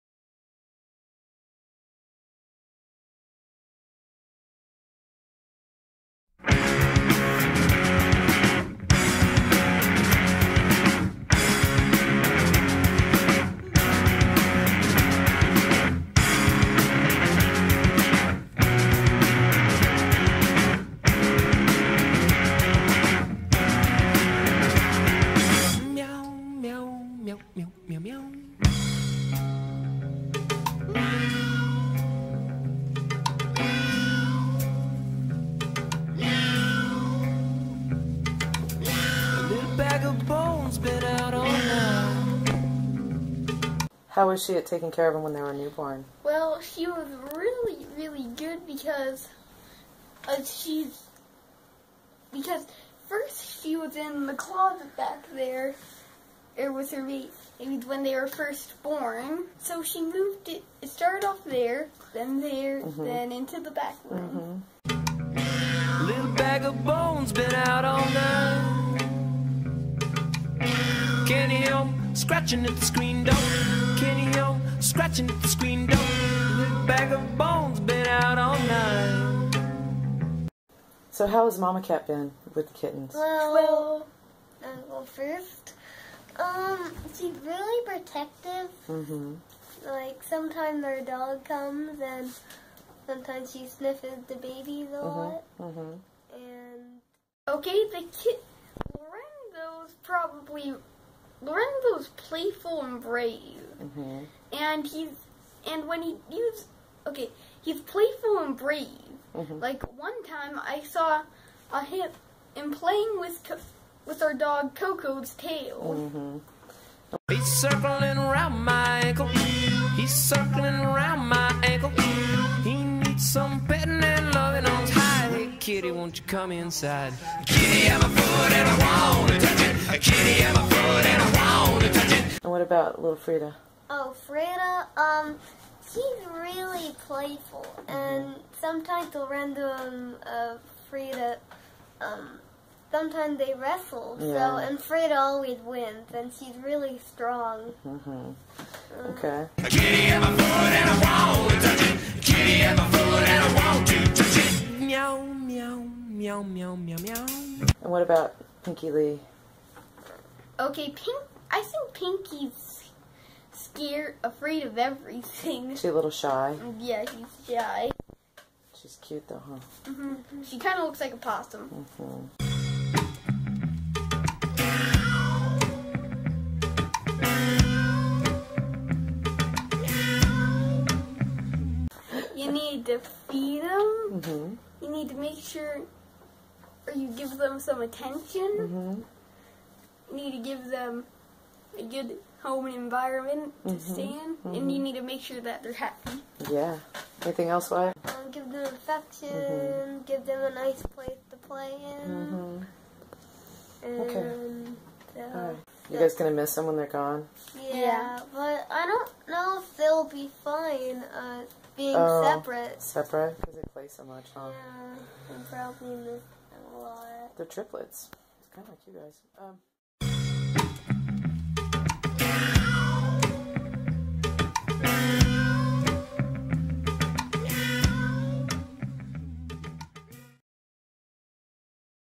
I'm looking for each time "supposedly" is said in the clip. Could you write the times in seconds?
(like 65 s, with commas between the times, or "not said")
not said.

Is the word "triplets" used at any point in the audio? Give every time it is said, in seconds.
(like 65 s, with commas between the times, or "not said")
217 s.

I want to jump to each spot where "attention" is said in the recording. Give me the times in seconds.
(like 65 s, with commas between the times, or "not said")
187 s.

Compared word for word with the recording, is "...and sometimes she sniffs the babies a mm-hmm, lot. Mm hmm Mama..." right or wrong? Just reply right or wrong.
wrong.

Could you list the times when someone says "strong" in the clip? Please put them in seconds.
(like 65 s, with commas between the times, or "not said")
147 s.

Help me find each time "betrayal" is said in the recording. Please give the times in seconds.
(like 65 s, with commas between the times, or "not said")
not said.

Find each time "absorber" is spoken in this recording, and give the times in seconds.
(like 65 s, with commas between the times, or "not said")
not said.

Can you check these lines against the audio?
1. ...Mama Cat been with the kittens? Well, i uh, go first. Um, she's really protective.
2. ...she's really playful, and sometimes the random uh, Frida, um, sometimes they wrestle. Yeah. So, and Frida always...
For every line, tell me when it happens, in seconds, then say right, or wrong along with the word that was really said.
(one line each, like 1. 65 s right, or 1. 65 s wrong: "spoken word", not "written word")
1. 81 s right
2. 135 s right.